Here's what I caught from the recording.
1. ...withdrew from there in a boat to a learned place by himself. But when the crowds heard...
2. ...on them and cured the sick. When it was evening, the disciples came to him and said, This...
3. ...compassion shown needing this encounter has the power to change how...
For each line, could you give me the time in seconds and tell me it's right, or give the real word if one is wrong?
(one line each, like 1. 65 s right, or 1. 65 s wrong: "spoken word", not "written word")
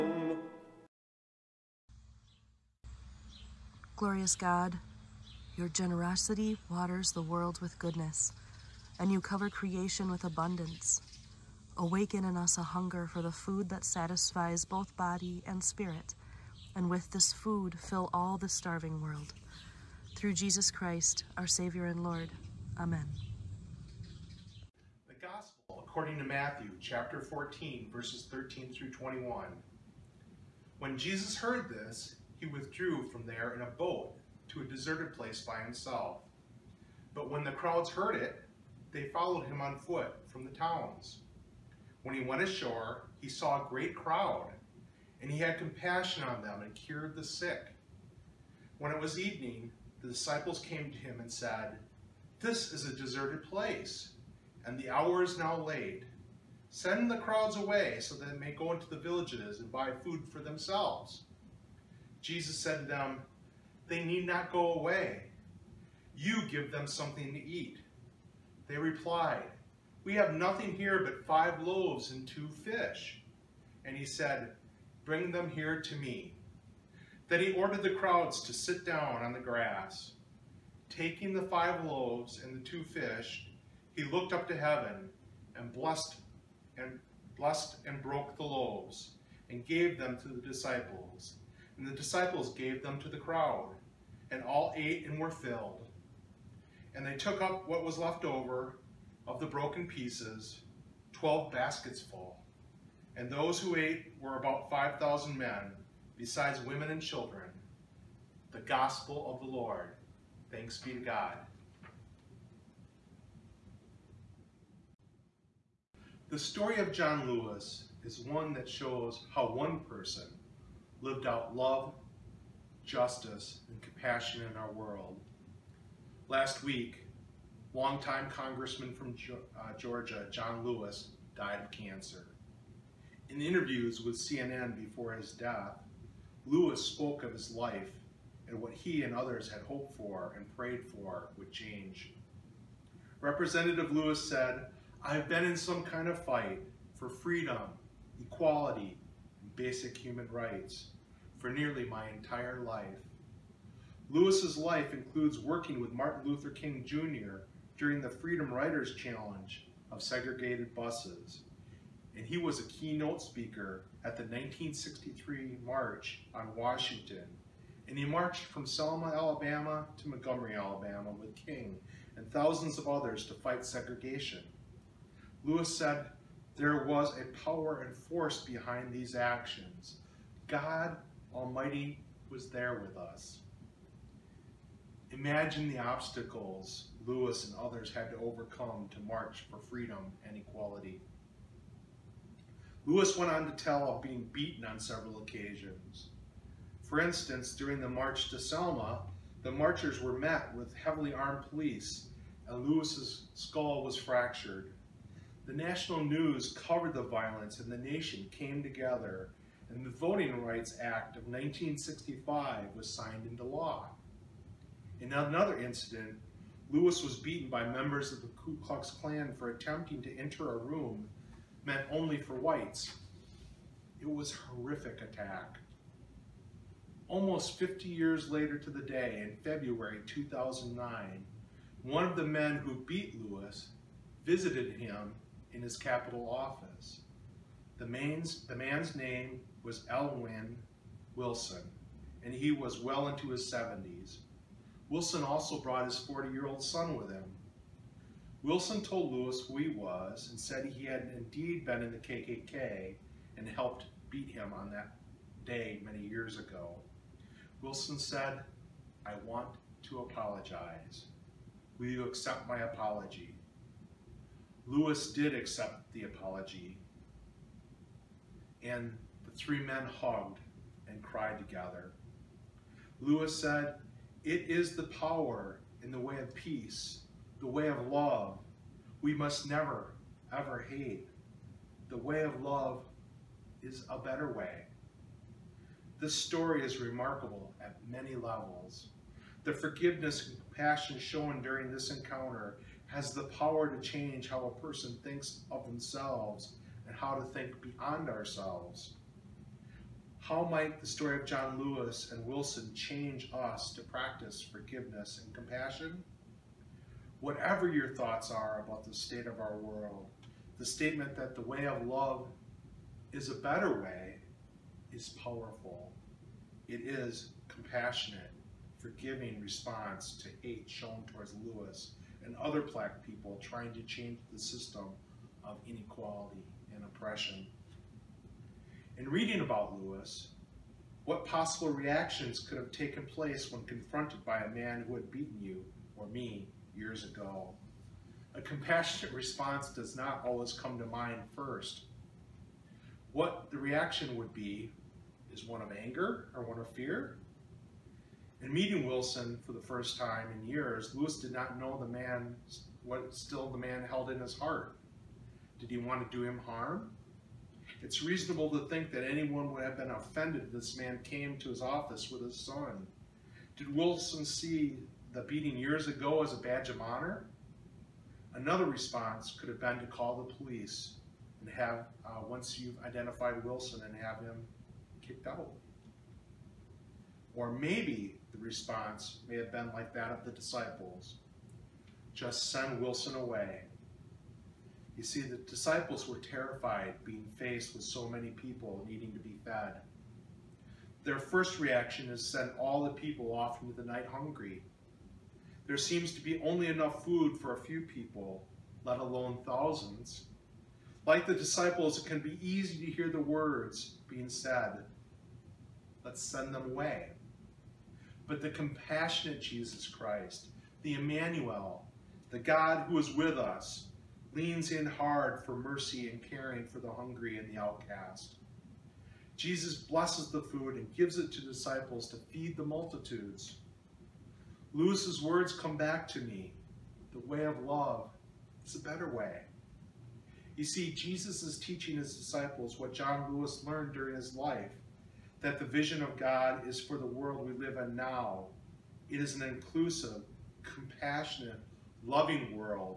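1. 32 s wrong: "deserted", not "learned"
2. 46 s right
3. 290 s wrong: "during", not "needing".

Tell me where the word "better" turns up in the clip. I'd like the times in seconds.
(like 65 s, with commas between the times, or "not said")
283 s, 313 s, 428 s.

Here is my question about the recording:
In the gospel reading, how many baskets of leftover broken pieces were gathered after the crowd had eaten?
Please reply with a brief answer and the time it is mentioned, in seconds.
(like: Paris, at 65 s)
12, at 101 s.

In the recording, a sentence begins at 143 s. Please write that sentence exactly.
Representative Lewis said, I've been in some kind of fight for freedom, equality, basic human rights for nearly my entire life.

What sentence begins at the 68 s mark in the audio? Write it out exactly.
They replied, We have nothing here but five loaves and two fish.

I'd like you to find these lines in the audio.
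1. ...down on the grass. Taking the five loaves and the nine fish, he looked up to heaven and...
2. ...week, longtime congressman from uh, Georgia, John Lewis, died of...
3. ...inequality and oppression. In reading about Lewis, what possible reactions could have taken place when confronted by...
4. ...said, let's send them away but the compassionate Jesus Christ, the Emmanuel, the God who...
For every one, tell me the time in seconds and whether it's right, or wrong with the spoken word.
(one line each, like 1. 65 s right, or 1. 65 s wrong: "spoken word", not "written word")
1. 78 s wrong: "two", not "nine"
2. 126 s right
3. 325 s right
4. 404 s right.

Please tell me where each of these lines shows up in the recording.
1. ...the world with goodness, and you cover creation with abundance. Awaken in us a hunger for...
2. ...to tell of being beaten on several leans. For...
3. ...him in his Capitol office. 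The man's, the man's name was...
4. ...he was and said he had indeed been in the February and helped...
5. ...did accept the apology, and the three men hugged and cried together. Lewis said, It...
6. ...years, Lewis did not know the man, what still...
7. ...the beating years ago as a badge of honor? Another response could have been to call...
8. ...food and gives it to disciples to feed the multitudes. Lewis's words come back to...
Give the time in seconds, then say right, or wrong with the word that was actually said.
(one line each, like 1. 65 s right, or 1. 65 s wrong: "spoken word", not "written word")
1. 7 s right
2. 193 s wrong: "occasions", not "leans"
3. 234 s right
4. 249 s wrong: "KKK", not "February"
5. 265 s right
6. 350 s right
7. 365 s right
8. 420 s right.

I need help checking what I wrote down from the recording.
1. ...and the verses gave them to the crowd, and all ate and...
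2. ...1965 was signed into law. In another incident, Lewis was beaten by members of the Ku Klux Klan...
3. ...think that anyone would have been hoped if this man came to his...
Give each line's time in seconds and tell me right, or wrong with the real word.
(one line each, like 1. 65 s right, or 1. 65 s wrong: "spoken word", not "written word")
1. 91 s wrong: "disciples", not "verses"
2. 211 s right
3. 358 s wrong: "offended", not "hoped".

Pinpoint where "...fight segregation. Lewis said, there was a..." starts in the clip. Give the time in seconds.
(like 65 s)
173 s.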